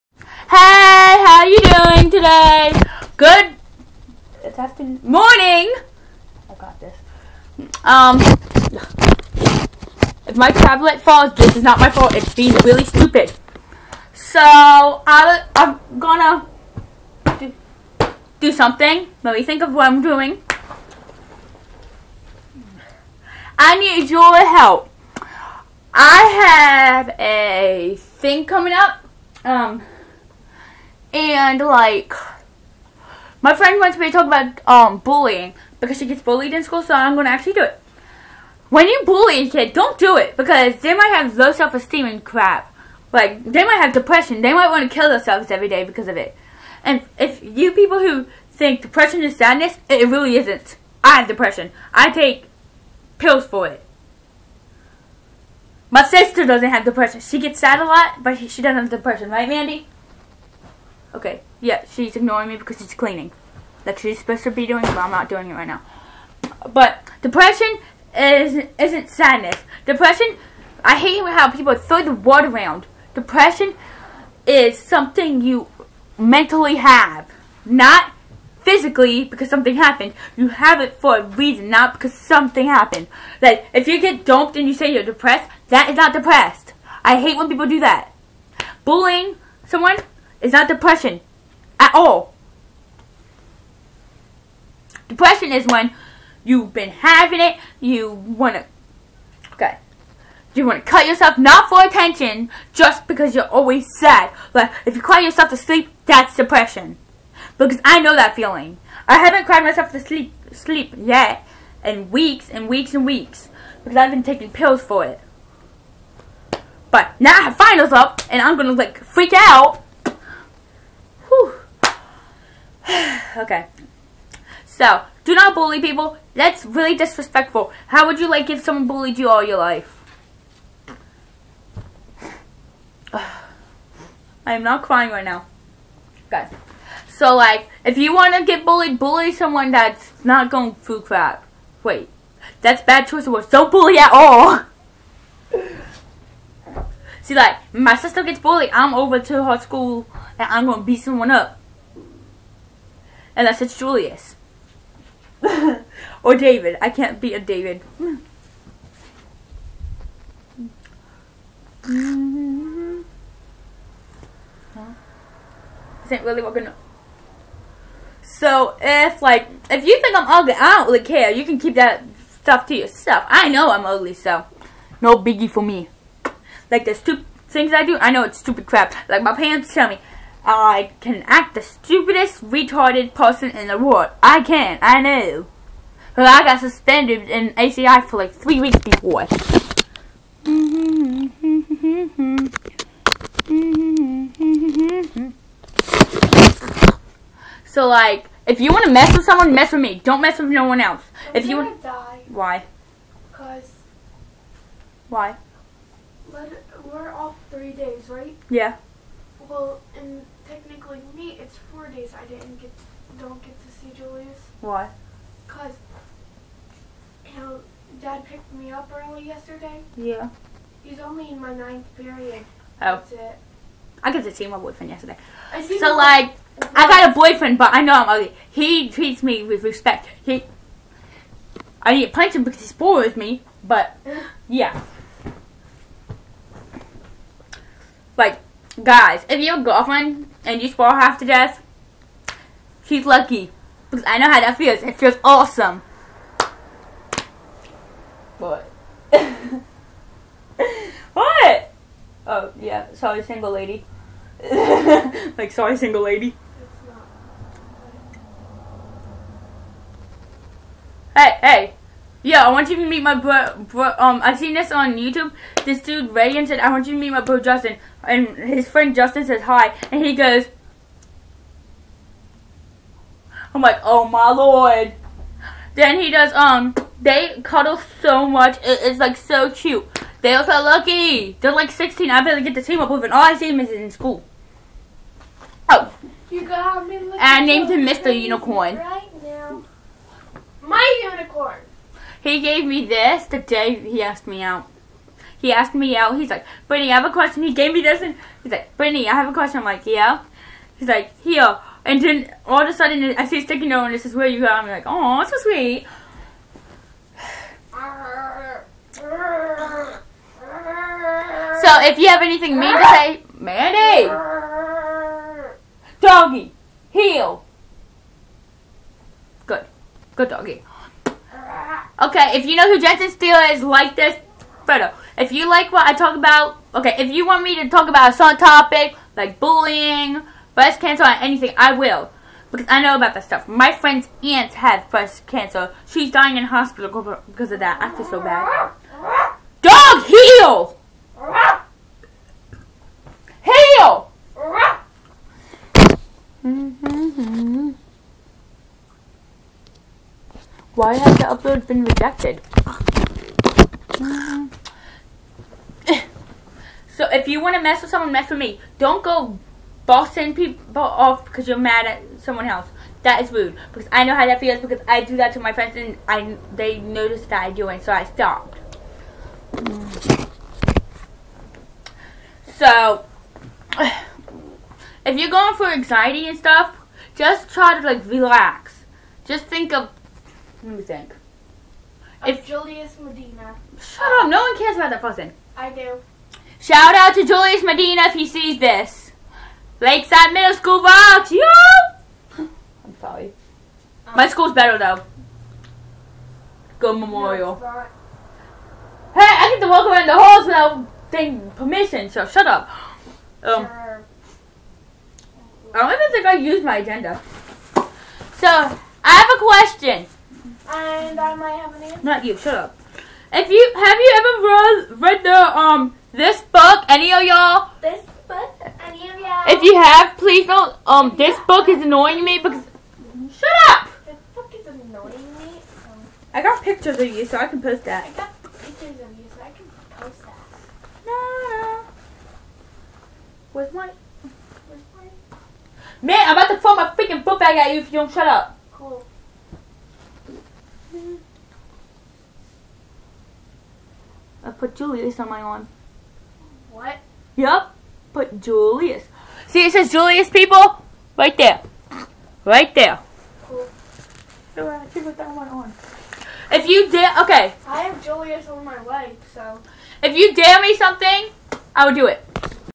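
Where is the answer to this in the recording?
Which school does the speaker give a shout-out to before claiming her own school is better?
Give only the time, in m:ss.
6:29.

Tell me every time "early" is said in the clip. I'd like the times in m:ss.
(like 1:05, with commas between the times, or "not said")
3:38.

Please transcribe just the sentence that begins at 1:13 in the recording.
Depression is something you mentally have, not physically because something happened.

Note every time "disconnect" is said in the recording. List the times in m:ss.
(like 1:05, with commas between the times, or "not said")
not said.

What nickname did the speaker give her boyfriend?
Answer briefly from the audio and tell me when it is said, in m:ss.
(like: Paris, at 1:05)
Mr. Unicorn, at 4:47.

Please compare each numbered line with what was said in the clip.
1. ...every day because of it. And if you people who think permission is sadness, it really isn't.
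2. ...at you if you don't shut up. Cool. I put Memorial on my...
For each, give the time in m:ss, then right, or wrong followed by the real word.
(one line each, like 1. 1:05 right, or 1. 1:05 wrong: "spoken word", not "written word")
1. 0:45 wrong: "depression", not "permission"
2. 7:17 wrong: "Julius", not "Memorial".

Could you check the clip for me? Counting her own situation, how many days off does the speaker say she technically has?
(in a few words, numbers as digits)
4 days.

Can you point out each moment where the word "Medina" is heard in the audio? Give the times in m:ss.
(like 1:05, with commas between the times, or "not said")
6:22, 6:27.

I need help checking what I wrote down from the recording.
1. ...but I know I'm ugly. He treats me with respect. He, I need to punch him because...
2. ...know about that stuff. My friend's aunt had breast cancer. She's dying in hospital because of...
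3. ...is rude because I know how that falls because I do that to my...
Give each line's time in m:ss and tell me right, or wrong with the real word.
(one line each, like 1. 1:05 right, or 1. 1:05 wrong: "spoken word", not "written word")
1. 3:47 right
2. 5:32 right
3. 6:03 wrong: "feels", not "falls".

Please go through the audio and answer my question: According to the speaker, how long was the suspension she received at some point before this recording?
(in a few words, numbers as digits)
3 weeks.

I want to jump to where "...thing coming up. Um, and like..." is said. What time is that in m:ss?
0:27.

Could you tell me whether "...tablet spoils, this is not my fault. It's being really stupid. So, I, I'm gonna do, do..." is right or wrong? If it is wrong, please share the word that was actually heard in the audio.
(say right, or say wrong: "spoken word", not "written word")
wrong: "falls", not "spoils".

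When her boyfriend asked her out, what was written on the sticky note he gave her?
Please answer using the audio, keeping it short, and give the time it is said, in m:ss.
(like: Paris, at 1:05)
Where you at?, at 5:04.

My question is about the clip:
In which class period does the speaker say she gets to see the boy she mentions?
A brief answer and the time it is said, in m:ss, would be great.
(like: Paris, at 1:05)
9th period, at 3:41.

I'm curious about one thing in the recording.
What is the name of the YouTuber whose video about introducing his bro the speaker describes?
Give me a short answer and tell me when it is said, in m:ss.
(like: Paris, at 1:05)
Reagan, at 4:26.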